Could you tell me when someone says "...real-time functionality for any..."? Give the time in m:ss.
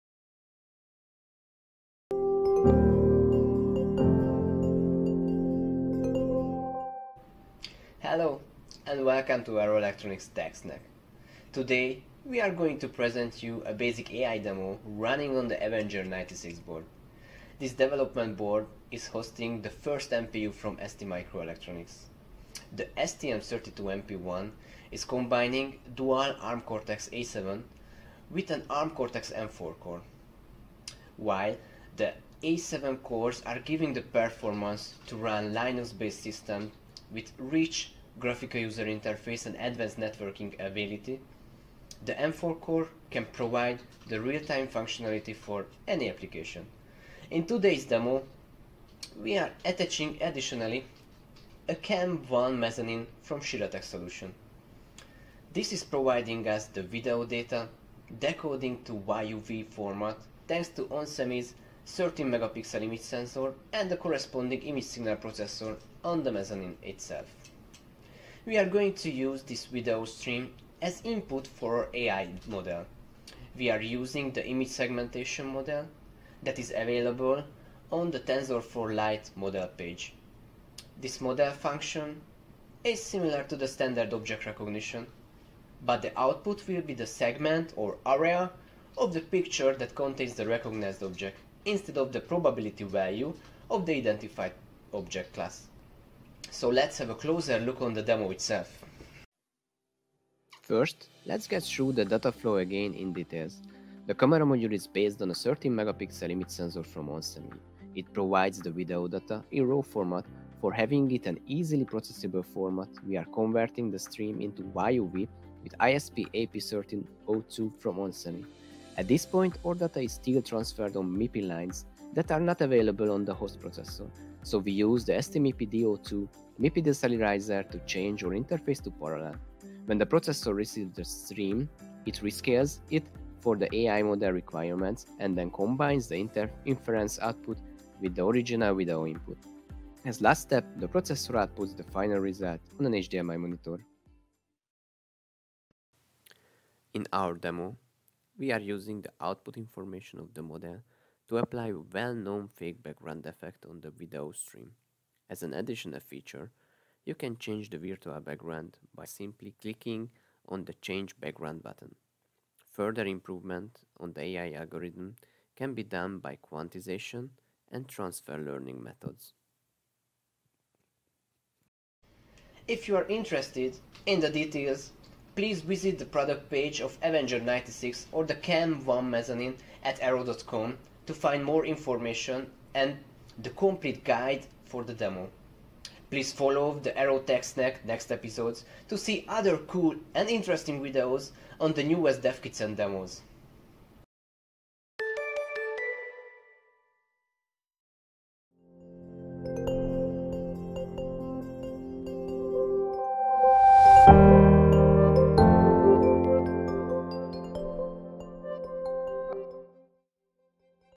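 0:44.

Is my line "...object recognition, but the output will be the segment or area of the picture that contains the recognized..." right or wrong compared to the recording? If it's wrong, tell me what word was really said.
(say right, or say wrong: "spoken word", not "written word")
right.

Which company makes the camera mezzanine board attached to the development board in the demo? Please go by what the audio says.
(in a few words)
Shiratech.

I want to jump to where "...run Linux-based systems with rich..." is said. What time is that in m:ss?
0:35.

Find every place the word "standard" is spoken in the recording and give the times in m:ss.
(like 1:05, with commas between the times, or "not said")
1:23.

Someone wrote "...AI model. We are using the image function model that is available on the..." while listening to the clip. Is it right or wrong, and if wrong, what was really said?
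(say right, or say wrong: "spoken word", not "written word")
wrong: "segmentation", not "function".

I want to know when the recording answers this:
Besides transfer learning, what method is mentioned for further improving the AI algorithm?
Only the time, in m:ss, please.
2:46.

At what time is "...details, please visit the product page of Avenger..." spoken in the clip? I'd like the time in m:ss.
2:54.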